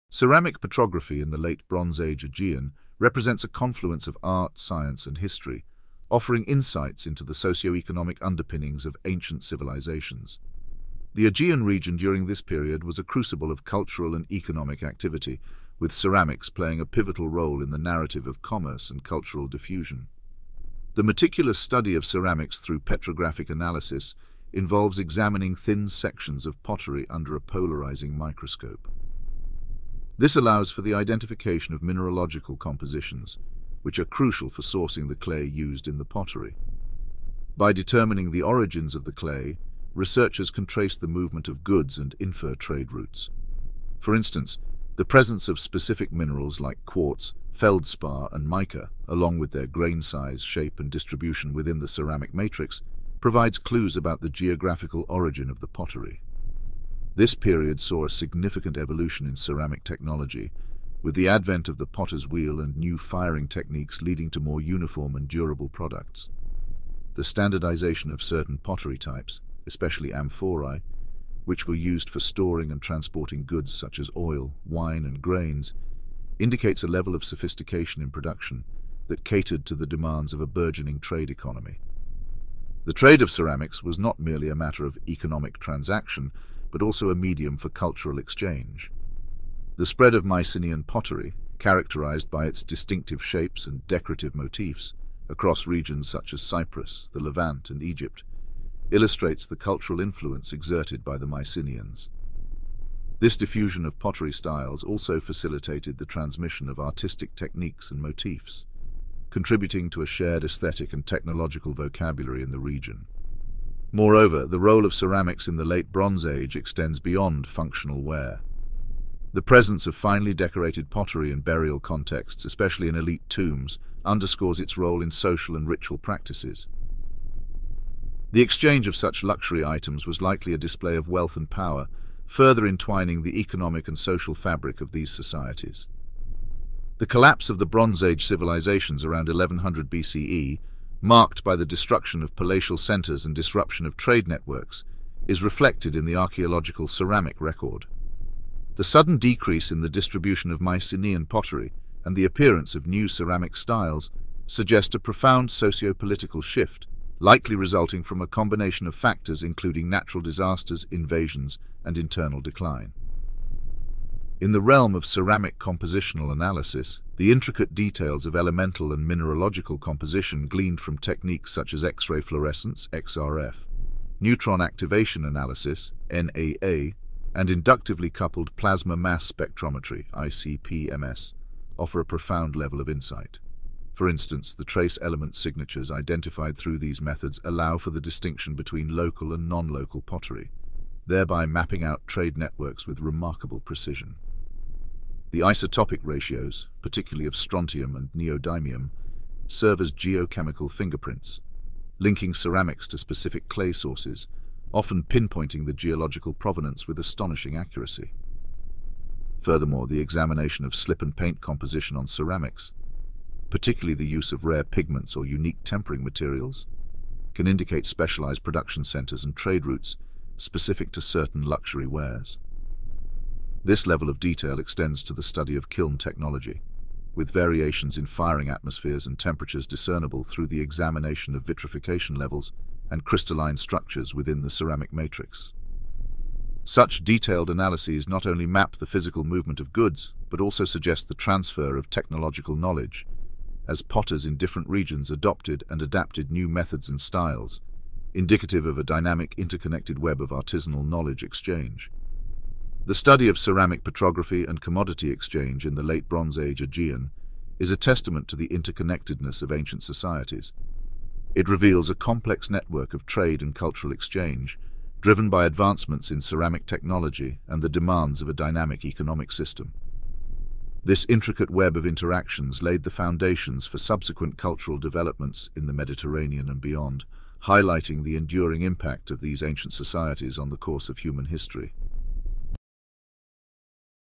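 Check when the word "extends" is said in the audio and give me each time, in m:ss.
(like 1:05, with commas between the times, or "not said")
1:56, 3:44.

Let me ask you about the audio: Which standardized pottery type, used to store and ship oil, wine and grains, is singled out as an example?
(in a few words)
Amphorae.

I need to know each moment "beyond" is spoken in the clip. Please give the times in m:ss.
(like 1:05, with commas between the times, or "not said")
1:57, 4:36.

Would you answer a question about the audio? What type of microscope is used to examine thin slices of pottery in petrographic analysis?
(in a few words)
Polarizing microscope.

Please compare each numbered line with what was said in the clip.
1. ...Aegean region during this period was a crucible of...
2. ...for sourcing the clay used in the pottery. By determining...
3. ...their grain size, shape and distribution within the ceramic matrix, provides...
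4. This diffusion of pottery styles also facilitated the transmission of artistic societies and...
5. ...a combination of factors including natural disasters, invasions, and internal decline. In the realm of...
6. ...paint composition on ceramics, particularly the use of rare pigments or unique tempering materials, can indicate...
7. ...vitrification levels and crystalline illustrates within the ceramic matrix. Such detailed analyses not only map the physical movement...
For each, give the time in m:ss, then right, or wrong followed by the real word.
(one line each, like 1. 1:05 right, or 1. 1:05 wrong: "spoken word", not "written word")
1. 0:11 right
2. 0:34 right
3. 0:49 right
4. 1:43 wrong: "techniques", not "societies"
5. 2:38 right
6. 3:31 right
7. 3:51 wrong: "structures", not "illustrates".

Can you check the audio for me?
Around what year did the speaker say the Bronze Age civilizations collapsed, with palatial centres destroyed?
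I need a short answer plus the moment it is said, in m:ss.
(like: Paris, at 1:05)
1100 BCE, at 2:19.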